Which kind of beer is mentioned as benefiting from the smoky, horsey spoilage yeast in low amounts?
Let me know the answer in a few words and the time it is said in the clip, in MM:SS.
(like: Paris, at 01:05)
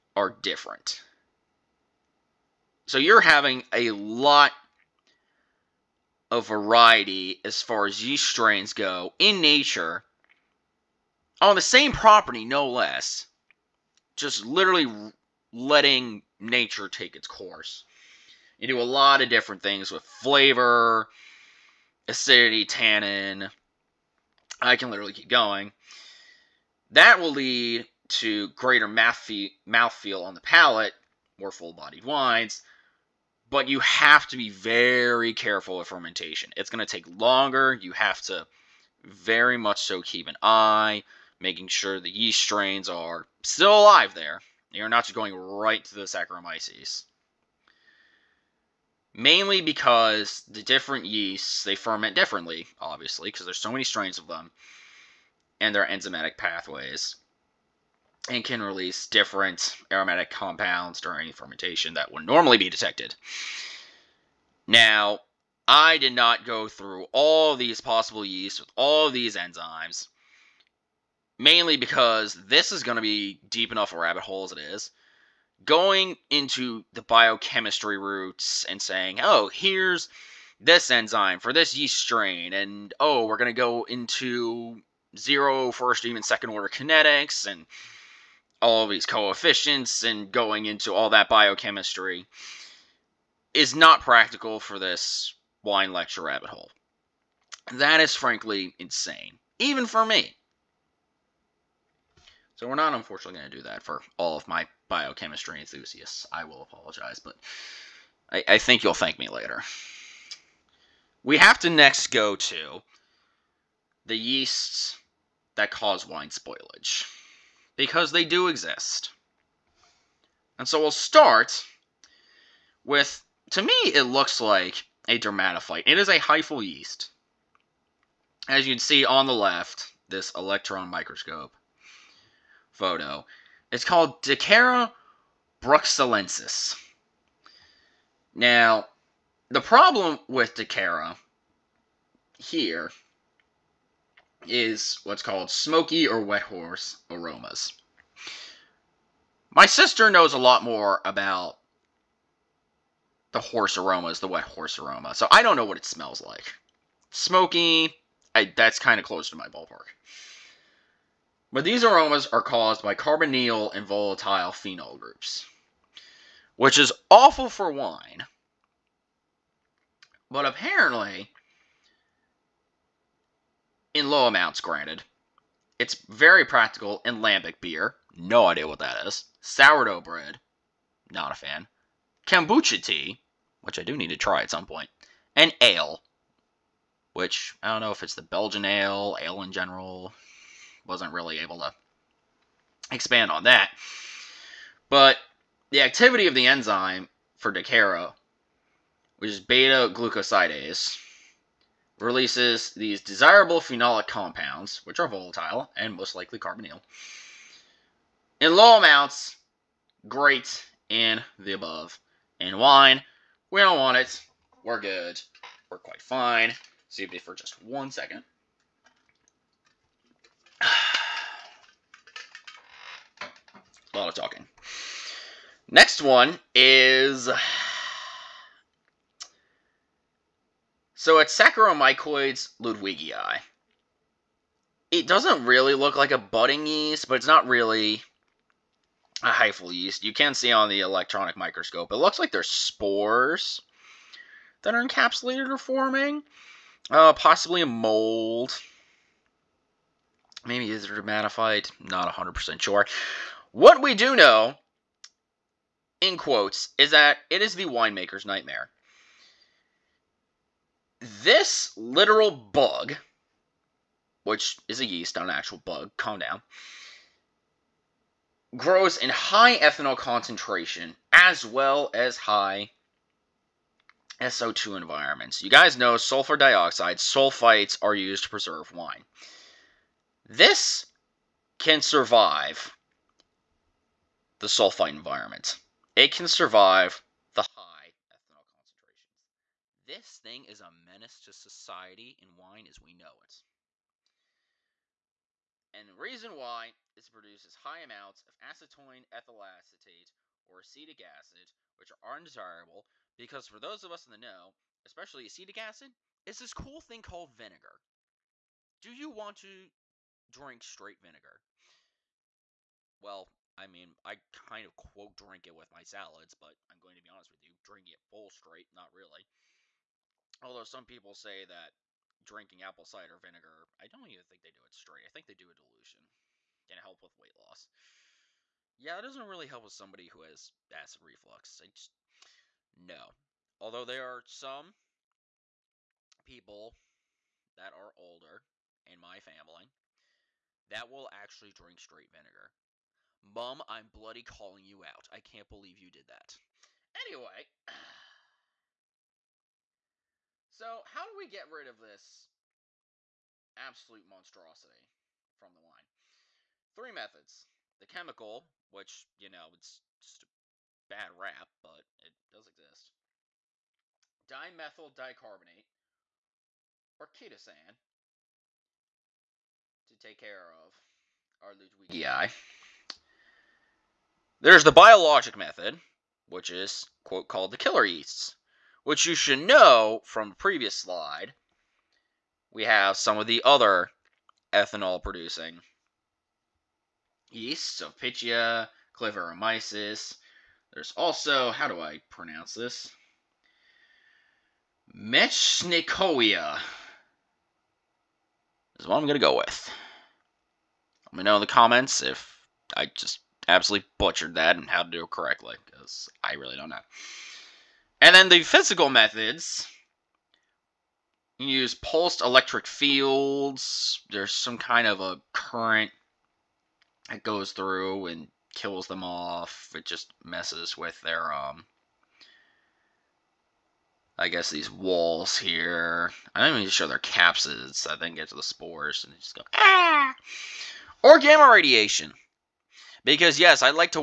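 Lambic beer, at 02:57.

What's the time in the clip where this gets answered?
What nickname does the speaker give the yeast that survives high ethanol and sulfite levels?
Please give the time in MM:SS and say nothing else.
04:17.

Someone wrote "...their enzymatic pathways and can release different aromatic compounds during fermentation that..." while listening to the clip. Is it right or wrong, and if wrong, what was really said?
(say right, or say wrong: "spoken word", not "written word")
right.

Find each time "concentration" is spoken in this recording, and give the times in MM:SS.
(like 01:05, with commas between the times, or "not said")
04:29, 04:48.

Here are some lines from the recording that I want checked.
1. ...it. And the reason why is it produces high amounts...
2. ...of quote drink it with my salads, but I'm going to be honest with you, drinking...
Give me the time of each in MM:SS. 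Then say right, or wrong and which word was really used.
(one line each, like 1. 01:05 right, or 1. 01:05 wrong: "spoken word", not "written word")
1. 04:53 right
2. 05:14 right.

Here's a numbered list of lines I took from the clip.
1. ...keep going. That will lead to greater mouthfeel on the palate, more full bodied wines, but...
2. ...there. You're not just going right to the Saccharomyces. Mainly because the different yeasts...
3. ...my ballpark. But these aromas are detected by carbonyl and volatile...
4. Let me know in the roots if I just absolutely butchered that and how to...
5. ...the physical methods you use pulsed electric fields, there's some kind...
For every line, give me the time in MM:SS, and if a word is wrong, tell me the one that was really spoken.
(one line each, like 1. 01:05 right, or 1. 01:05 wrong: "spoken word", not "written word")
1. 00:25 right
2. 00:44 right
3. 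02:39 wrong: "caused", not "detected"
4. 06:41 wrong: "comments", not "roots"
5. 06:48 right.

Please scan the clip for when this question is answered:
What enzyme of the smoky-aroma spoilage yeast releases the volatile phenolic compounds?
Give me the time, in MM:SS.
03:19.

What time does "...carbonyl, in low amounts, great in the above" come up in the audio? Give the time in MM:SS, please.
03:26.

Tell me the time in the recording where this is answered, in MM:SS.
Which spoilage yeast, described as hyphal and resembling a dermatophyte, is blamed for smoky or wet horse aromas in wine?
02:14.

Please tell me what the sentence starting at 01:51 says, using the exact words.
We have to next go to the yeasts that cause wine spoilage because they do exist.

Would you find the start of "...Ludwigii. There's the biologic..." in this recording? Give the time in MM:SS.
06:11.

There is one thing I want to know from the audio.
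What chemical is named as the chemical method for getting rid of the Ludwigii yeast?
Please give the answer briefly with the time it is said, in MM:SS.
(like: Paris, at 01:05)
Dimethyl dicarbonate, at 06:04.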